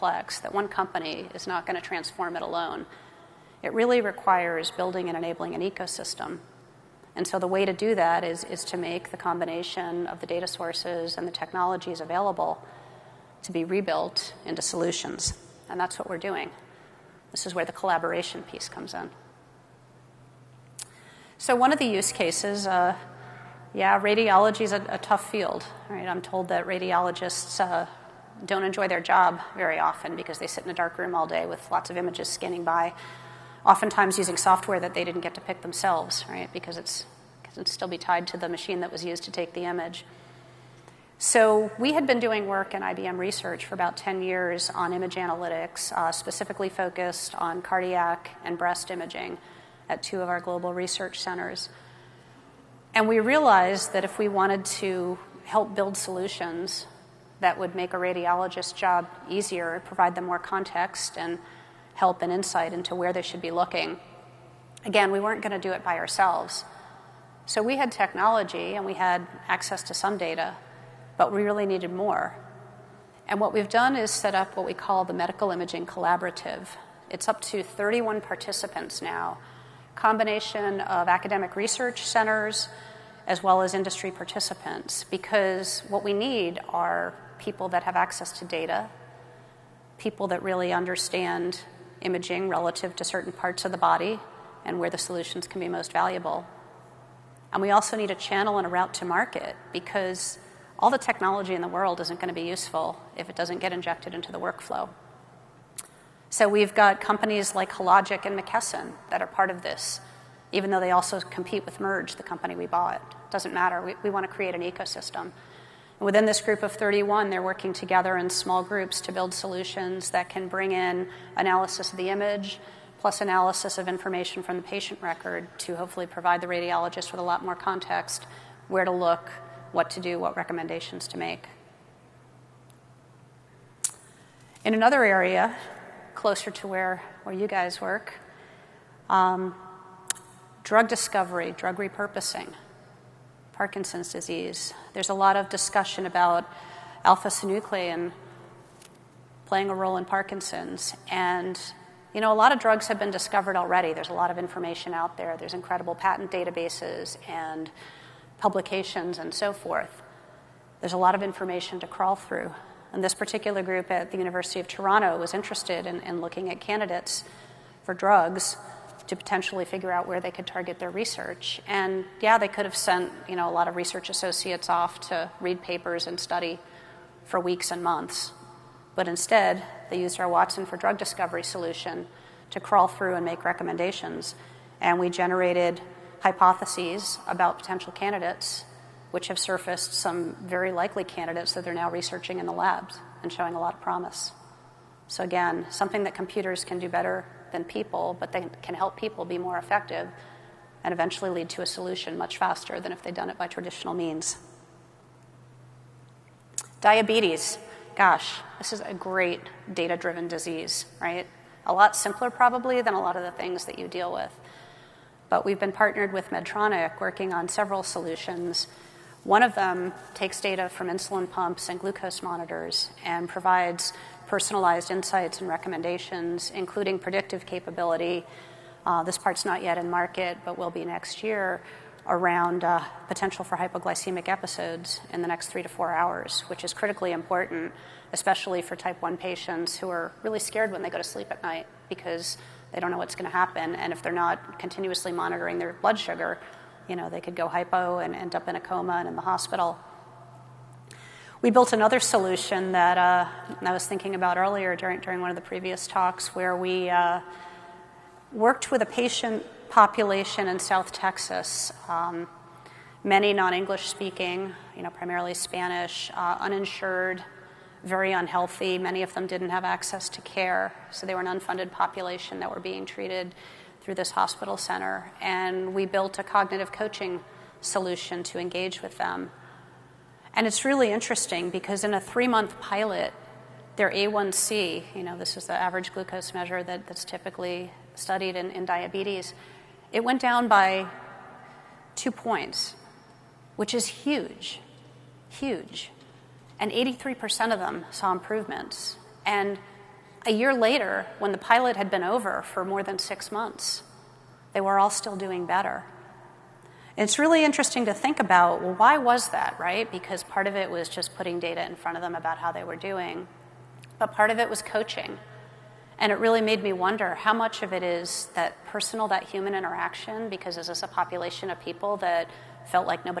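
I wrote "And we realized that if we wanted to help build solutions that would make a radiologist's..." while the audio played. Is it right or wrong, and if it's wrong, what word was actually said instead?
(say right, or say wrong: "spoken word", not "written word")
right.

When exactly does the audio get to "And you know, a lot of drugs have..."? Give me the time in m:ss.
2:31.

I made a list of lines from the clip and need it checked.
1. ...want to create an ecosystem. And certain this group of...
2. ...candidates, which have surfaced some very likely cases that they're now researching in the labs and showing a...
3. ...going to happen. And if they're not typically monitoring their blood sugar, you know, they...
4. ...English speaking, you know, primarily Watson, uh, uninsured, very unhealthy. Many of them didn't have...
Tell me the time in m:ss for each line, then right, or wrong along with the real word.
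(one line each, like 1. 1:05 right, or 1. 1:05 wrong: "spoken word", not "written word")
1. 1:54 wrong: "within", not "certain"
2. 3:07 wrong: "candidates", not "cases"
3. 4:03 wrong: "continuously", not "typically"
4. 4:23 wrong: "Spanish", not "Watson".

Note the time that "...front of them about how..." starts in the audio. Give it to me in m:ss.
5:11.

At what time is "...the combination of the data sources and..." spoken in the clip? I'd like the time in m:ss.
0:09.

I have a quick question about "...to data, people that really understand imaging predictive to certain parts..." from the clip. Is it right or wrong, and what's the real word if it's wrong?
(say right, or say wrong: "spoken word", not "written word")
wrong: "relative", not "predictive".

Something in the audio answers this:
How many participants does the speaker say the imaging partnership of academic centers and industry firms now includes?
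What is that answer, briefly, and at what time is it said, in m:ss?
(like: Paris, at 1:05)
31, at 1:17.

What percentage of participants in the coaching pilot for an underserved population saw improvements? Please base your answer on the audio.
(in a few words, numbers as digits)
83%.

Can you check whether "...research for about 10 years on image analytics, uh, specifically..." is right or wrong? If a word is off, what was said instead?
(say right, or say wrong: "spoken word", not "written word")
right.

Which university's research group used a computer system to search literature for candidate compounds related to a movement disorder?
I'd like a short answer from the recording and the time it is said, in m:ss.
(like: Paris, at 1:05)
University of Toronto, at 2:44.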